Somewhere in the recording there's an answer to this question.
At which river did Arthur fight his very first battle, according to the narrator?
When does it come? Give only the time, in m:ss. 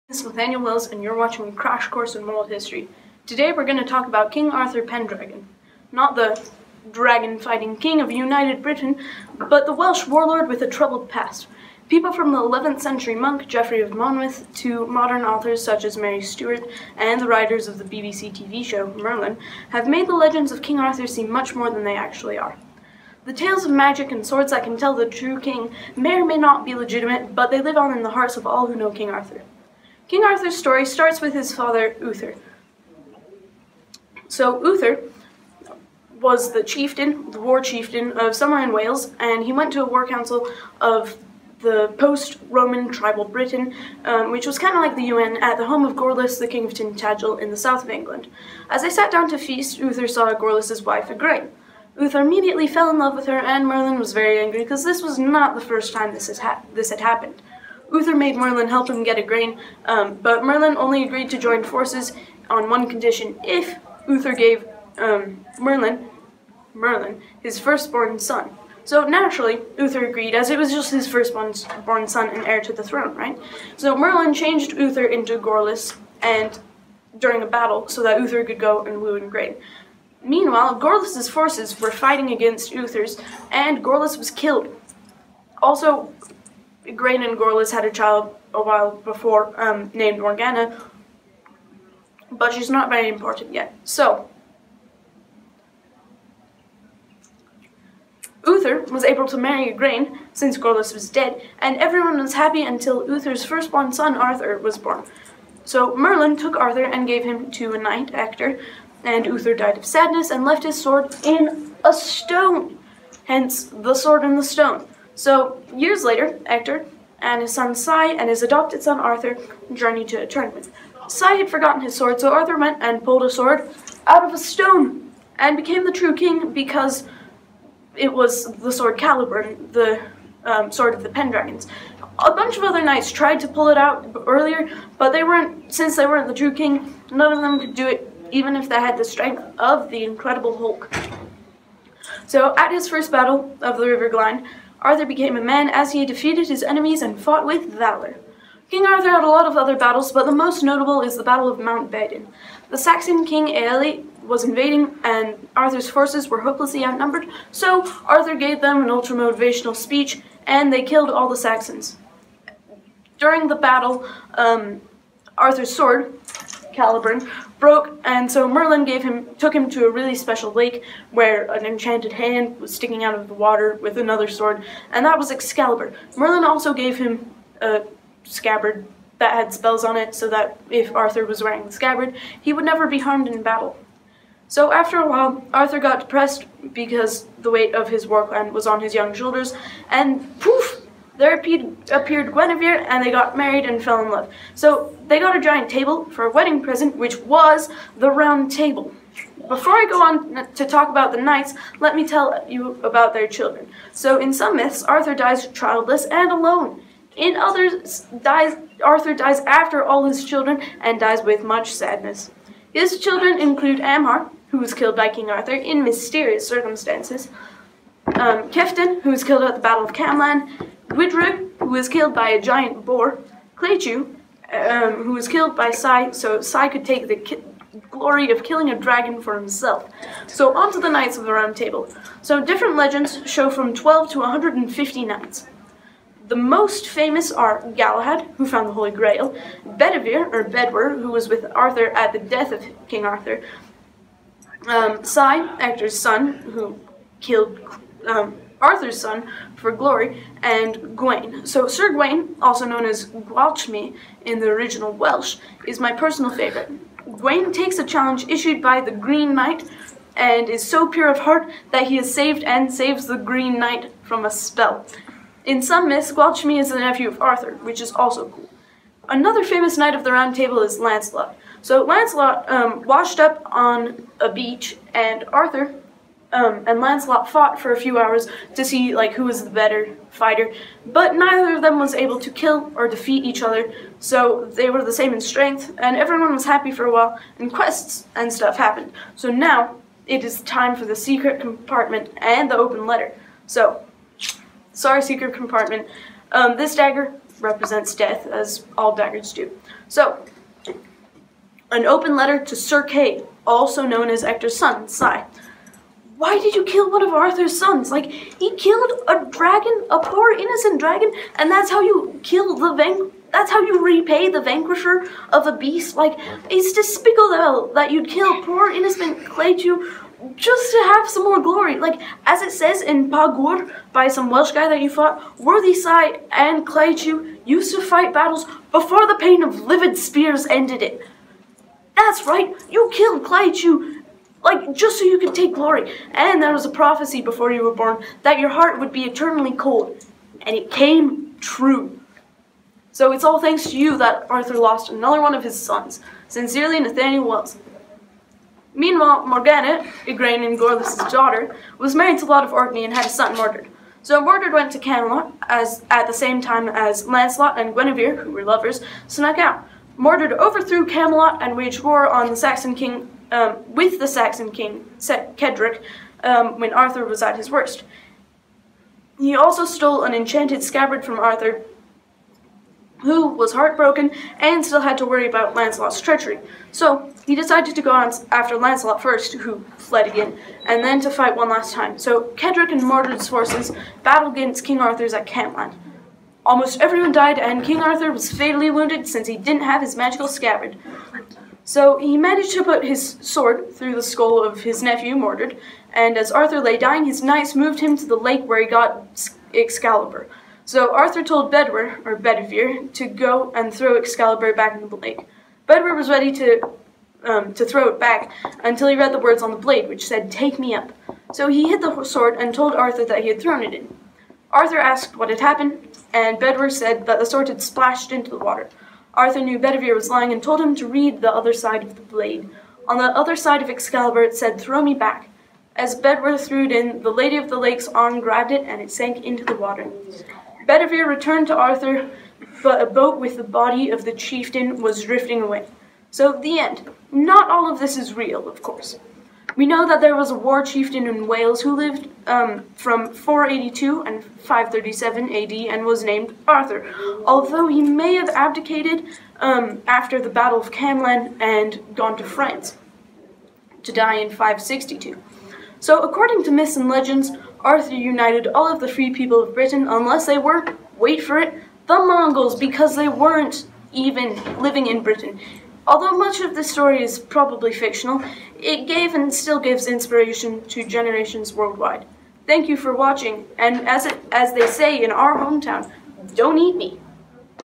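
2:23.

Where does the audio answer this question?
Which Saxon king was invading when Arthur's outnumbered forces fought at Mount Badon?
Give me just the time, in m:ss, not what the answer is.
2:33.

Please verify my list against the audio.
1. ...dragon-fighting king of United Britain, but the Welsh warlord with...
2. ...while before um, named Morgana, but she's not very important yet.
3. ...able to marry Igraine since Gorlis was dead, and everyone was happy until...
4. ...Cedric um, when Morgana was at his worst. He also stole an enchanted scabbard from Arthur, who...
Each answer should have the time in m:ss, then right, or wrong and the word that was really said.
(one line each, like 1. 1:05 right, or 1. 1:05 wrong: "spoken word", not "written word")
1. 0:06 right
2. 1:28 right
3. 1:39 right
4. 6:04 wrong: "Arthur", not "Morgana".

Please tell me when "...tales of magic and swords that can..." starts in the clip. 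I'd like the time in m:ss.
0:23.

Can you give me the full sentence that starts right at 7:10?
Bedivere returned to Arthur, but a boat with the body of the chieftain was drifting away.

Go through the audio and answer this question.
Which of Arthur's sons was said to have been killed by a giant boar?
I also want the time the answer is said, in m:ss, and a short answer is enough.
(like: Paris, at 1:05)
Gwidrig, at 3:40.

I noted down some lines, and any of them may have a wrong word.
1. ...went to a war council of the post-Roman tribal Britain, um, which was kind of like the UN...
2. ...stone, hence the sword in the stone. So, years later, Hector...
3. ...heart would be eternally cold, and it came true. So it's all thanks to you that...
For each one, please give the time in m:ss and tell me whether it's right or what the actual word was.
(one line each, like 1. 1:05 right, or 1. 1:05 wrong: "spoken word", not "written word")
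1. 0:39 right
2. 1:51 right
3. 5:38 right.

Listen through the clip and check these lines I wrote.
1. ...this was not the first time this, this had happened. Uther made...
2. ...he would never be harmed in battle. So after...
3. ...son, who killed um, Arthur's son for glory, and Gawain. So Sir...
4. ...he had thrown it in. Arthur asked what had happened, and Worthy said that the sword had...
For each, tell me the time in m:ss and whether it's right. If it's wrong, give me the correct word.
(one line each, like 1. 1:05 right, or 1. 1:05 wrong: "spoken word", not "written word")
1. 0:54 right
2. 3:02 right
3. 4:05 right
4. 6:53 wrong: "Bedwyr", not "Worthy".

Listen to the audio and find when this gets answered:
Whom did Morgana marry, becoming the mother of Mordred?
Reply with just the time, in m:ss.
5:52.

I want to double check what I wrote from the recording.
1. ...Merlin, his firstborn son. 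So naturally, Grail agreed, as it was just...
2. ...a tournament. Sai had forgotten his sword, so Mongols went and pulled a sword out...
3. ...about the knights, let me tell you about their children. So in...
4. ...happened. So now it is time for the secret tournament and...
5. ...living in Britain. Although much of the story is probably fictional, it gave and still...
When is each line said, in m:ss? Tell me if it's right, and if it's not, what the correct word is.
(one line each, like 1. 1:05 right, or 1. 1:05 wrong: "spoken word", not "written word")
1. 1:06 wrong: "Uther", not "Grail"
2. 2:00 wrong: "Arthur", not "Mongols"
3. 3:20 right
4. 4:48 wrong: "compartment", not "tournament"
5. 7:44 right.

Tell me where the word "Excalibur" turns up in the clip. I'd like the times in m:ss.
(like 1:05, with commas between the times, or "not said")
2:55, 6:39, 6:43, 7:03.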